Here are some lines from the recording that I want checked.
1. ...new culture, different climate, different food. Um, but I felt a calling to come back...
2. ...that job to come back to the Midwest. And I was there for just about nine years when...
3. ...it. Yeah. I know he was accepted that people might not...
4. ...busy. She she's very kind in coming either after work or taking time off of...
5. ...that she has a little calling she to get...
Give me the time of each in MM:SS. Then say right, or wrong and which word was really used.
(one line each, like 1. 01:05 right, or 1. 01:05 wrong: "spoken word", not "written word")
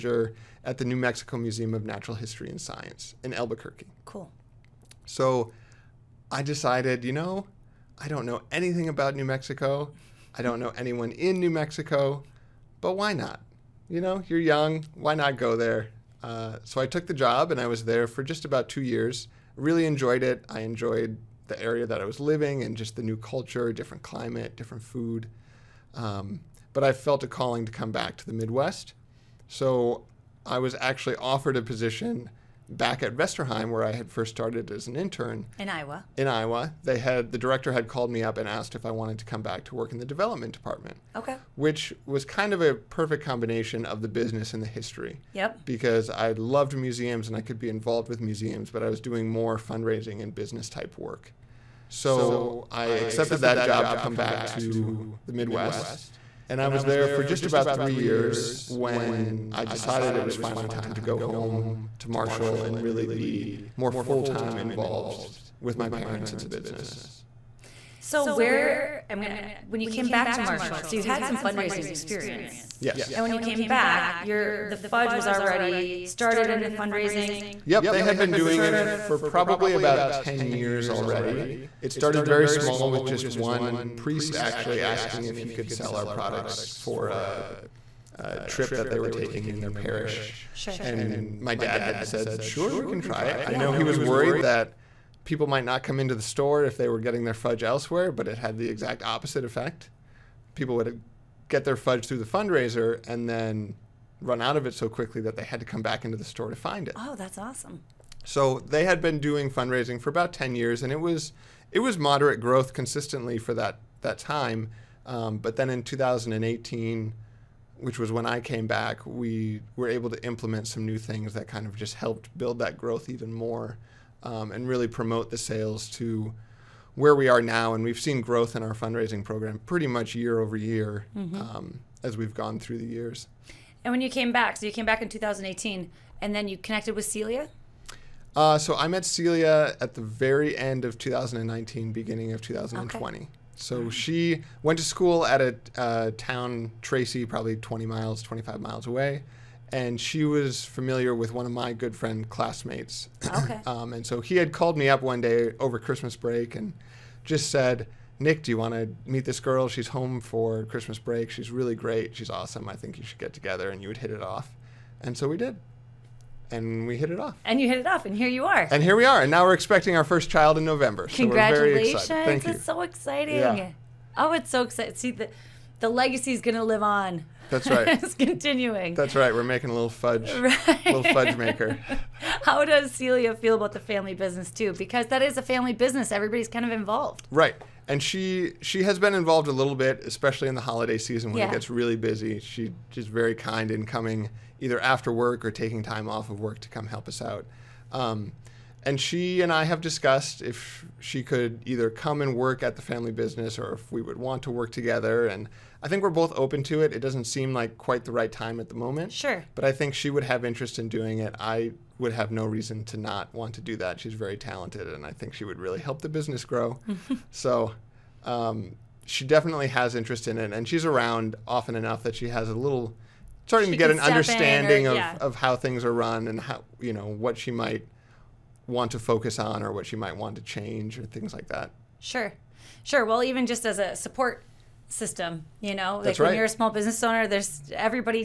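1. 00:23 right
2. 00:53 wrong: "three", not "nine"
3. 01:33 wrong: "worried", not "accepted"
4. 03:11 right
5. 03:42 wrong: "starting", not "calling".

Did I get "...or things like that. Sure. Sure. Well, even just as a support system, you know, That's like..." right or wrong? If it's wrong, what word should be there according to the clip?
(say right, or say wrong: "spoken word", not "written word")
right.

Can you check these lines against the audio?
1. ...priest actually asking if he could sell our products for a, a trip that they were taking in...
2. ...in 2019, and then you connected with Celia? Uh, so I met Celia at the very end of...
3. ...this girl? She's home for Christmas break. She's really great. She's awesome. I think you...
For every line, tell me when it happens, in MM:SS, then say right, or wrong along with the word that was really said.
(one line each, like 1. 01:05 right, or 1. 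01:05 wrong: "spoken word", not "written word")
1. 01:23 right
2. 02:15 wrong: "2018", not "2019"
3. 02:39 right.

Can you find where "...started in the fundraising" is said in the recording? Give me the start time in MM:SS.
01:16.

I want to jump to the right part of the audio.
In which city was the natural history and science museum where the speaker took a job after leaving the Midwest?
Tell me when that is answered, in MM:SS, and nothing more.
00:03.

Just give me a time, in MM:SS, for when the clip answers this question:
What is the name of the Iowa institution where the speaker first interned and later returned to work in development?
00:33.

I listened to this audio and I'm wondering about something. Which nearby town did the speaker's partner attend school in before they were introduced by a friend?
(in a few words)
Tracy.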